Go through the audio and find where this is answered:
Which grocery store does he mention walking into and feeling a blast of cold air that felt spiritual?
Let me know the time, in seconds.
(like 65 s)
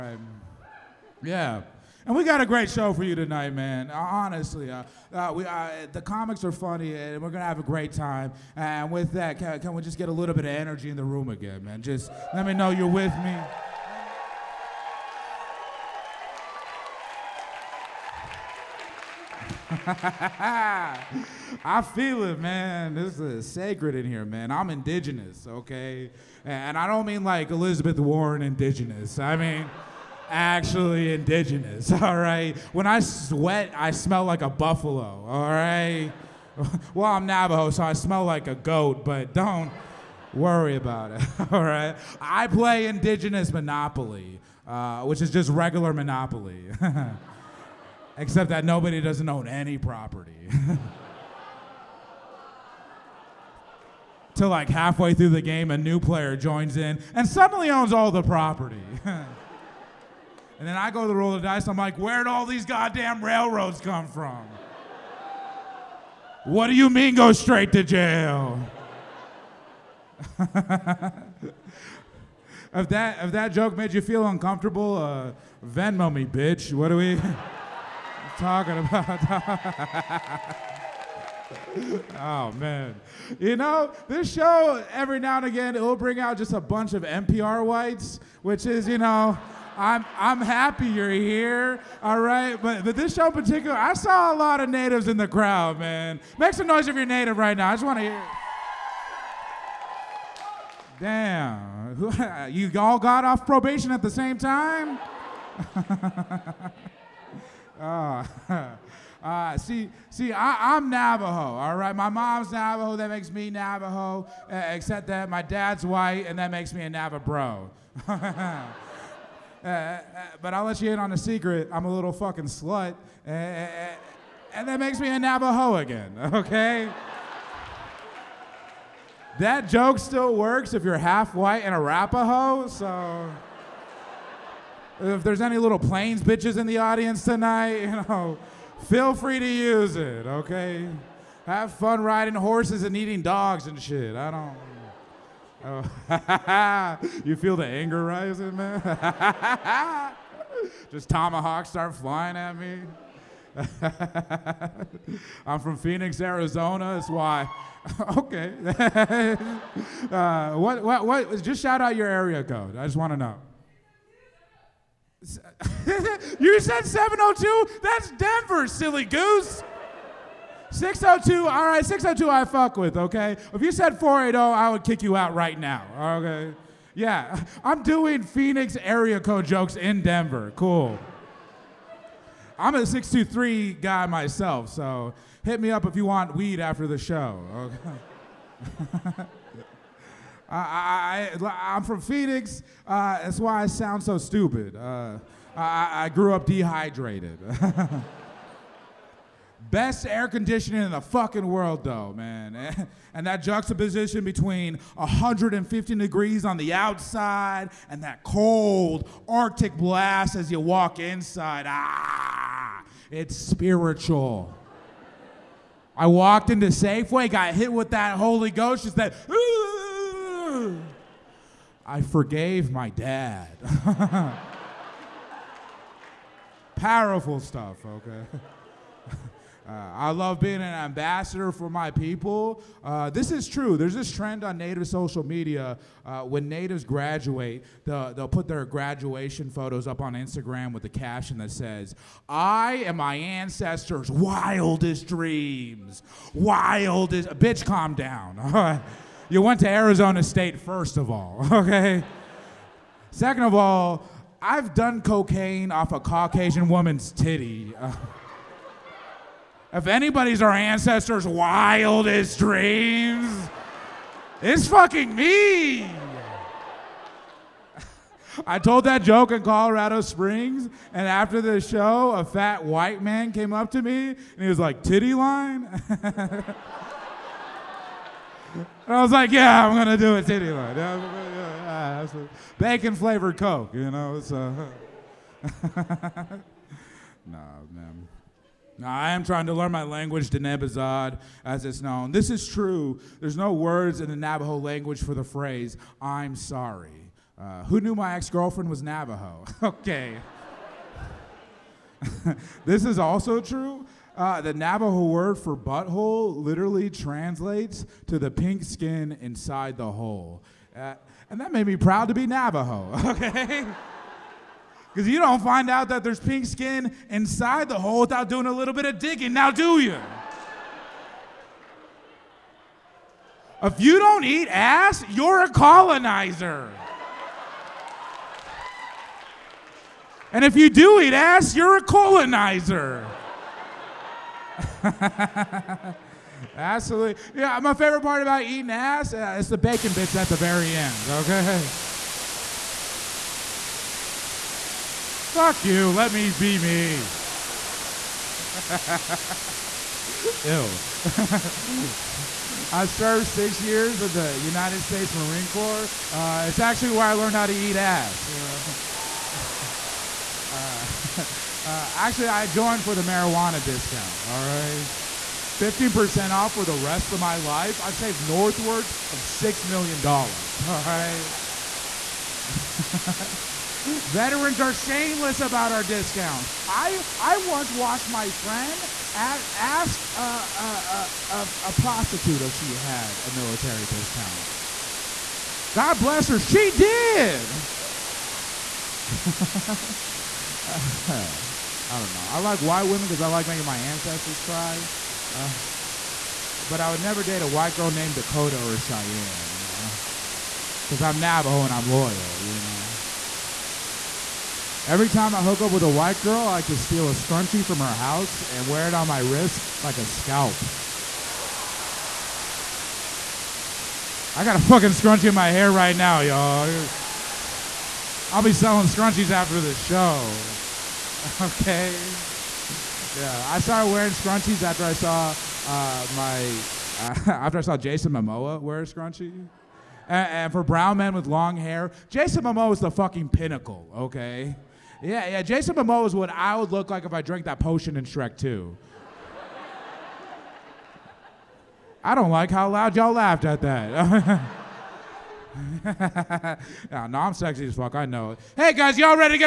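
216 s.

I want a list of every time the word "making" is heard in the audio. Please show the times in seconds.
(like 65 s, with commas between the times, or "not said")
393 s.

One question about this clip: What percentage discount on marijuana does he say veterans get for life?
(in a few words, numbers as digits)
15%.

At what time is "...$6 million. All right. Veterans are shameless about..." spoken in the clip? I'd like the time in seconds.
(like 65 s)
369 s.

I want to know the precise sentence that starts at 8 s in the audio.
And with that, can, can, we just get a little bit of energy in the room again, man?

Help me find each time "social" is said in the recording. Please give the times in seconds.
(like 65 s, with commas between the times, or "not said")
234 s.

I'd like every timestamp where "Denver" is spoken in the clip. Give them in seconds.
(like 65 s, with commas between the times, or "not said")
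168 s, 180 s.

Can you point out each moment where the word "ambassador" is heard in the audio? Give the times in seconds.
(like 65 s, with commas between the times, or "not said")
230 s.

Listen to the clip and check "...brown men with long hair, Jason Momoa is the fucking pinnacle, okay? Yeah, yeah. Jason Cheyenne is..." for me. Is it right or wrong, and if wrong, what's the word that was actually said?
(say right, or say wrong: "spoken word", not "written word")
wrong: "Momoa", not "Cheyenne".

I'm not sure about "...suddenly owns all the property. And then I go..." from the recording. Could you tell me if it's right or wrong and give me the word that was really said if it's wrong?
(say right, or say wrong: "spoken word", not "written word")
right.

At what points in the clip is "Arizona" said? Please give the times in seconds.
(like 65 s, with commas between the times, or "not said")
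156 s, 249 s.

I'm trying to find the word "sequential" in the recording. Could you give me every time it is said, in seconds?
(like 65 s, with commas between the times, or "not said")
not said.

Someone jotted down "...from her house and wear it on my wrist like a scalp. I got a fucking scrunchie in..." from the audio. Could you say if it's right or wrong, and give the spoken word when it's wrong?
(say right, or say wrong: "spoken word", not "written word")
right.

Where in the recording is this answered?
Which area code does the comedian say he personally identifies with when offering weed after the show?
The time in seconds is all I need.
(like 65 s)
182 s.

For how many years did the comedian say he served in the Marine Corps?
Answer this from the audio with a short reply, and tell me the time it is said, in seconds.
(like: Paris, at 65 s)
6 years, at 353 s.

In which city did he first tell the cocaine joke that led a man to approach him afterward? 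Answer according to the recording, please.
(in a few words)
Colorado Springs.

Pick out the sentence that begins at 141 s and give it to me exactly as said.
Have fun riding horses and eating dogs and shit.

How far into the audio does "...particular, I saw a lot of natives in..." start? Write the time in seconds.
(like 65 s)
93 s.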